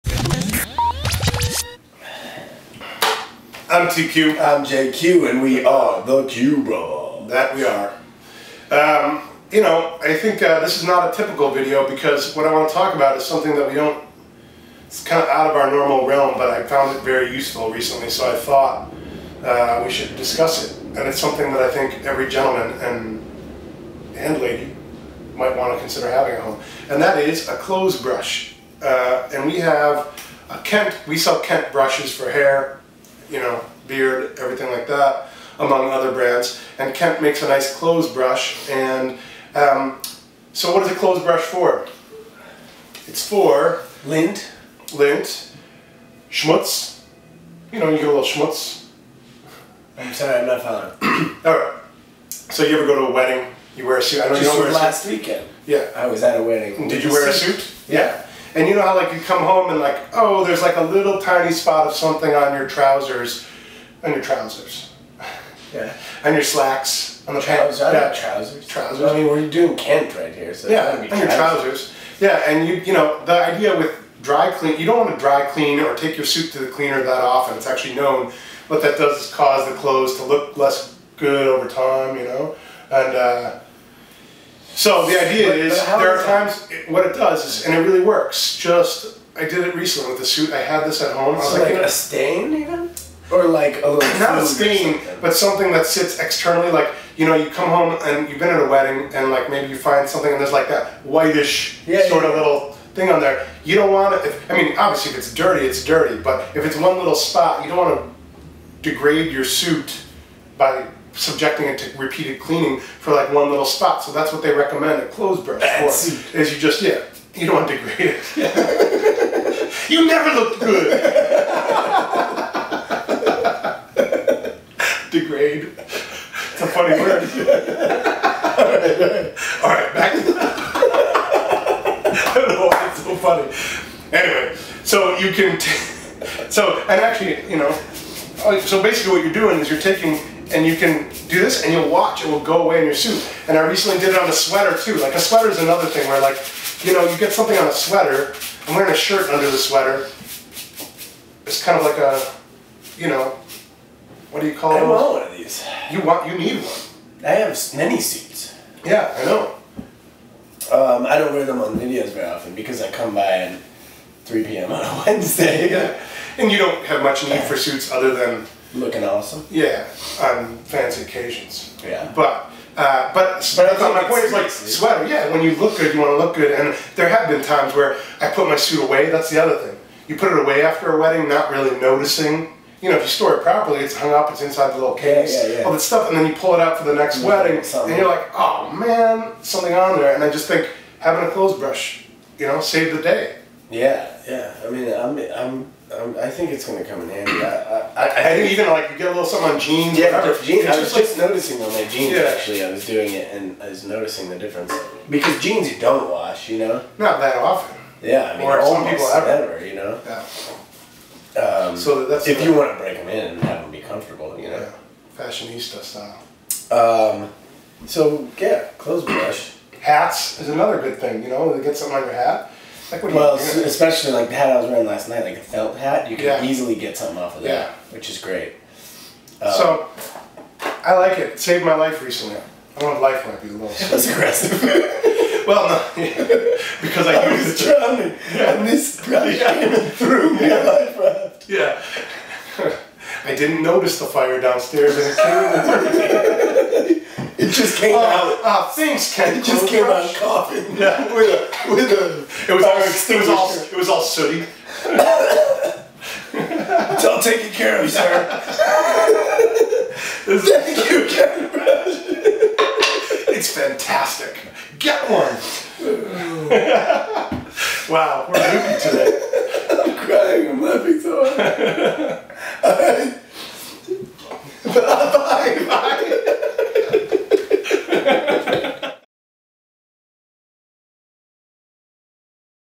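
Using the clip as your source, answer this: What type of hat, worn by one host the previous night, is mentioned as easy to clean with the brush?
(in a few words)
A felt hat.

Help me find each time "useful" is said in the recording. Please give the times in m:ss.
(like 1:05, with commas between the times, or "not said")
0:17.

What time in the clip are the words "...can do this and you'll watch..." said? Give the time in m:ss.
2:20.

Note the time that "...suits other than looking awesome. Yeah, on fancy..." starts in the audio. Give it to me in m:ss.
2:47.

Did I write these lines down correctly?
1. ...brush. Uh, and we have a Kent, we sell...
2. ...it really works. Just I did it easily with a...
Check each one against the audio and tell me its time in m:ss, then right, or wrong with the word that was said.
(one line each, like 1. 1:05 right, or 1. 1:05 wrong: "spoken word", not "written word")
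1. 0:28 right
2. 1:27 wrong: "recently", not "easily".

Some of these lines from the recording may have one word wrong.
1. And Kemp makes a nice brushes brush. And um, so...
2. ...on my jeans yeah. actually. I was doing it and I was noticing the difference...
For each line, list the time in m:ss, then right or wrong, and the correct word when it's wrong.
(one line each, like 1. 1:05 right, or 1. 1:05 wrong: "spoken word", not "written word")
1. 0:36 wrong: "clothes", not "brushes"
2. 3:21 right.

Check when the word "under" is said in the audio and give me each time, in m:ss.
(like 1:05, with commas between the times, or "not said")
2:29.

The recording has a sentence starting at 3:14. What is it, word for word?
I mean, I'm, I'm, I'm, i think it's gonna come in handy.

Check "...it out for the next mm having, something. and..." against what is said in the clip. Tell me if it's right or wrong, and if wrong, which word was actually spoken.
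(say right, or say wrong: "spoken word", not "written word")
wrong: "wedding", not "having".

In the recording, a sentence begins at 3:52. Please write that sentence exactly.
I if life might be a little.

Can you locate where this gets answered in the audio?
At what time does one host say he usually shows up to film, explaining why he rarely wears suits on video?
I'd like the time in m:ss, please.
2:44.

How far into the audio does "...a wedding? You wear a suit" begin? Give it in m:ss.
0:53.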